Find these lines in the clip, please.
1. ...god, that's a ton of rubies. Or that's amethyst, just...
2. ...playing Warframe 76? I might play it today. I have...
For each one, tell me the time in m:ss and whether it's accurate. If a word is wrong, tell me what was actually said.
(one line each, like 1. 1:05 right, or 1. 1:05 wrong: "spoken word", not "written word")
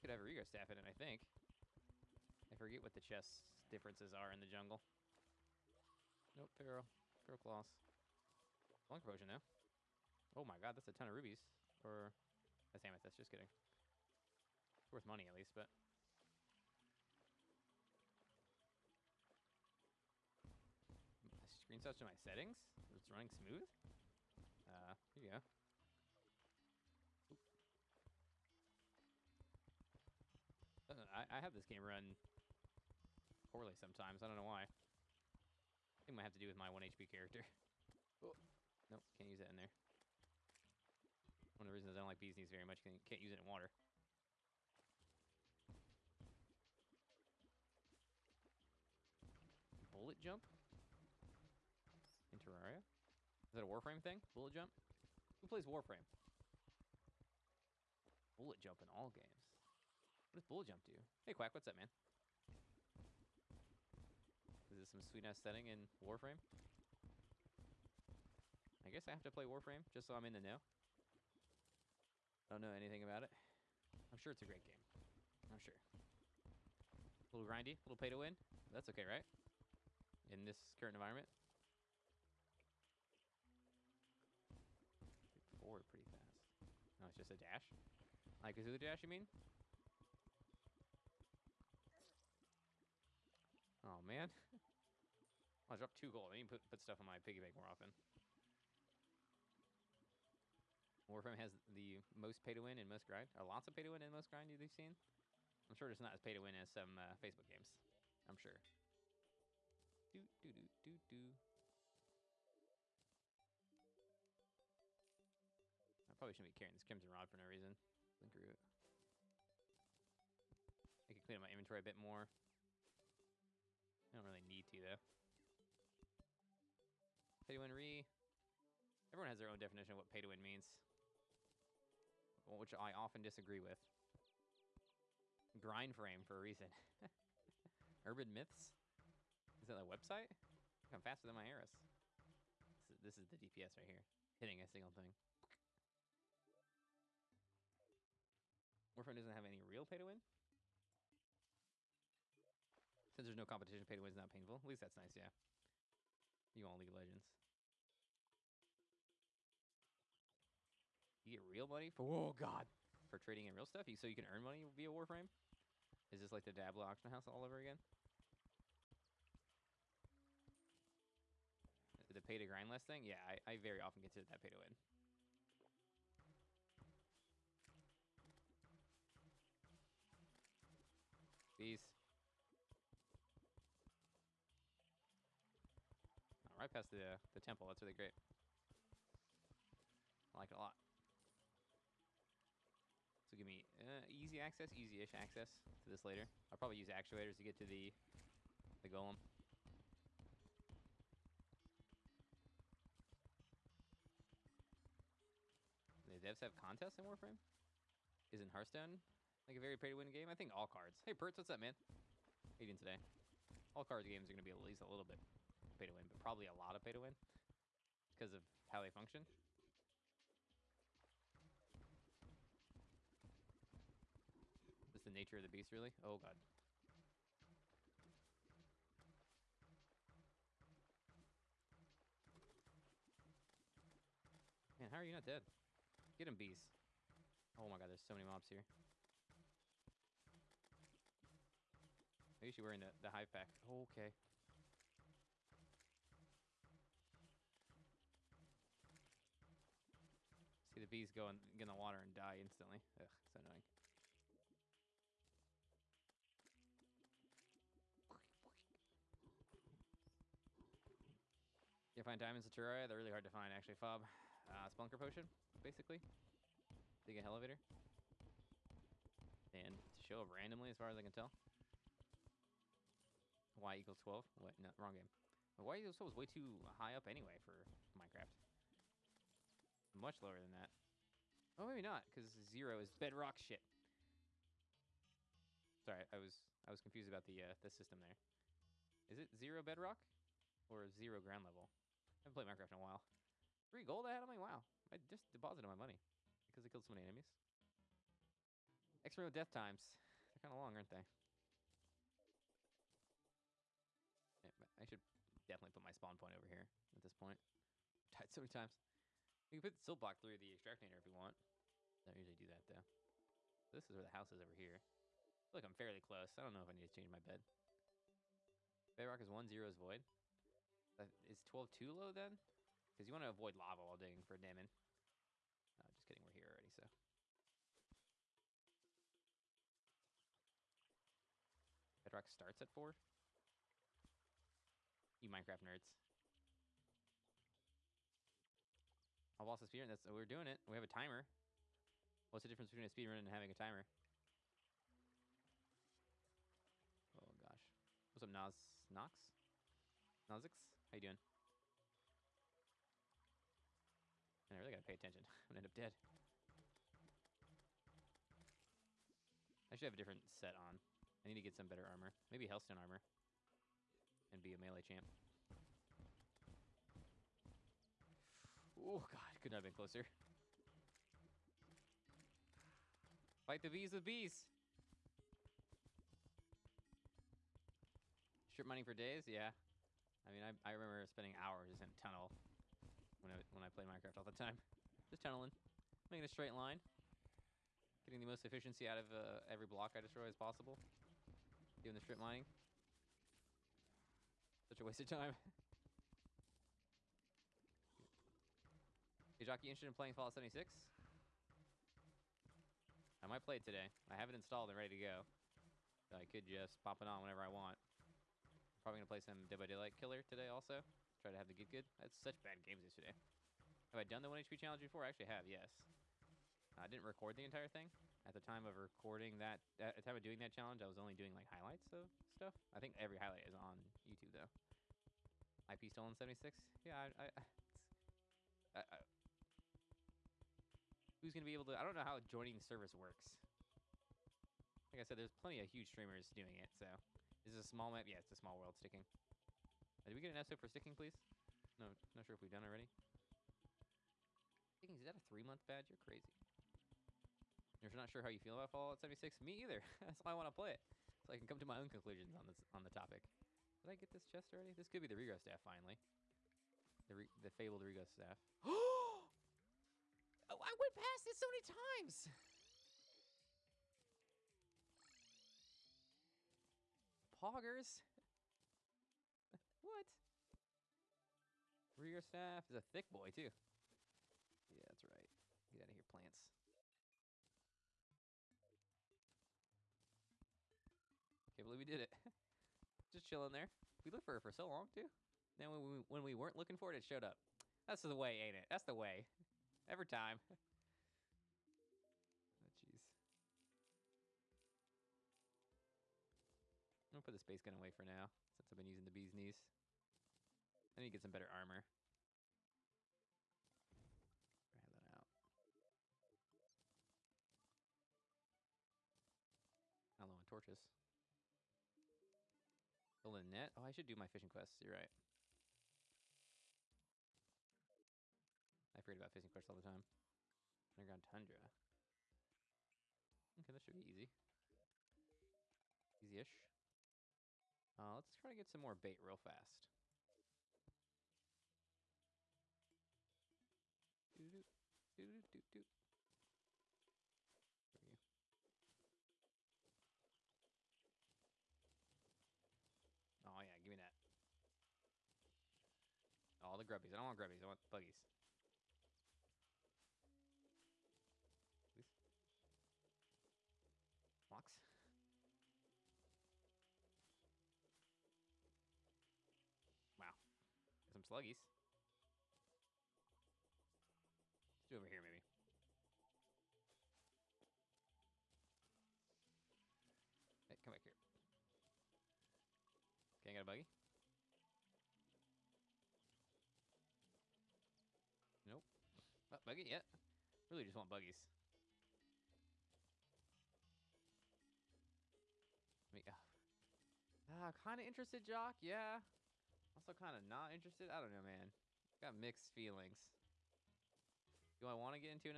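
1. 0:10 right
2. 6:39 wrong: "Fallout", not "Warframe".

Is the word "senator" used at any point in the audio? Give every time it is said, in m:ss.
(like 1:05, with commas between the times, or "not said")
not said.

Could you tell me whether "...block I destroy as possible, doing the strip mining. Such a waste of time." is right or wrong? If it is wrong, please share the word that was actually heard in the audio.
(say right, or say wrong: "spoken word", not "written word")
right.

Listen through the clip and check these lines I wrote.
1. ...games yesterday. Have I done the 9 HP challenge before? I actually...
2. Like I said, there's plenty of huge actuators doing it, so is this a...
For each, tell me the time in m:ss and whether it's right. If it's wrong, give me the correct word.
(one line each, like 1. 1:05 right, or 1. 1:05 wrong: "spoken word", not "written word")
1. 6:52 wrong: "1", not "9"
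2. 7:14 wrong: "streamers", not "actuators".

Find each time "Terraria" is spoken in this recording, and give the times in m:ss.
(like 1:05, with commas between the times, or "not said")
0:52, 4:22.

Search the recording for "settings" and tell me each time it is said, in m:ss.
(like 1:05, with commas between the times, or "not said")
0:22, 1:05.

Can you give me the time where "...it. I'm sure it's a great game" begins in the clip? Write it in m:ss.
1:13.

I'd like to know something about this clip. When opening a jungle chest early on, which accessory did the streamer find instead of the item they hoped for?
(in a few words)
Feral Claws.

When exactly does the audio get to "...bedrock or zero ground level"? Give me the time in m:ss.
4:49.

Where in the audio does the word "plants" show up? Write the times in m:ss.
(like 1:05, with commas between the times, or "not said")
7:56.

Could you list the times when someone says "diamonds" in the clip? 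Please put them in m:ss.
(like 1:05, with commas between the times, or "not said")
4:22, 5:24.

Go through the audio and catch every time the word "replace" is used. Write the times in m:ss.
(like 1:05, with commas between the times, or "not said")
not said.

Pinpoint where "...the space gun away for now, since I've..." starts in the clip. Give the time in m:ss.
8:17.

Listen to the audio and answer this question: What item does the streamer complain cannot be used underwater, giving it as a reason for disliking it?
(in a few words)
Bees Knees.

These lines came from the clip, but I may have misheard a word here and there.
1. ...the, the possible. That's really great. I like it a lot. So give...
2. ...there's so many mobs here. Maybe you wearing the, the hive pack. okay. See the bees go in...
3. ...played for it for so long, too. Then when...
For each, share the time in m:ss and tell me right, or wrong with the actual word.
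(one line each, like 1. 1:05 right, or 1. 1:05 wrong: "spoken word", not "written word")
1. 3:06 wrong: "temple", not "possible"
2. 3:57 right
3. 8:04 wrong: "looked", not "played".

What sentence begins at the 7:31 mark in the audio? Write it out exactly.
So I can come to my own conclusions on this on the topic.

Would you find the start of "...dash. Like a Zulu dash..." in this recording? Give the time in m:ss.
1:27.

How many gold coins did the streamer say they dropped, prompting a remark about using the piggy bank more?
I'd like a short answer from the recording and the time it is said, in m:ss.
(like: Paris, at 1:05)
2, at 1:35.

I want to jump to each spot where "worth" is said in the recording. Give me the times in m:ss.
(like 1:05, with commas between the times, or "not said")
0:14.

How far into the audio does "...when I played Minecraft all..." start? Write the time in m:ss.
6:23.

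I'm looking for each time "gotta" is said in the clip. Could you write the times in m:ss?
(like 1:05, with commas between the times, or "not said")
5:54.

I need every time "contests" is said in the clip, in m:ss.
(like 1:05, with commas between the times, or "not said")
3:26.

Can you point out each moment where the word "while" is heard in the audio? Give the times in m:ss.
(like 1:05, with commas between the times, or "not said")
4:52, 5:23.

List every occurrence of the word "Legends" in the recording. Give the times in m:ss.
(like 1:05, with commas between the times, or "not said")
2:36.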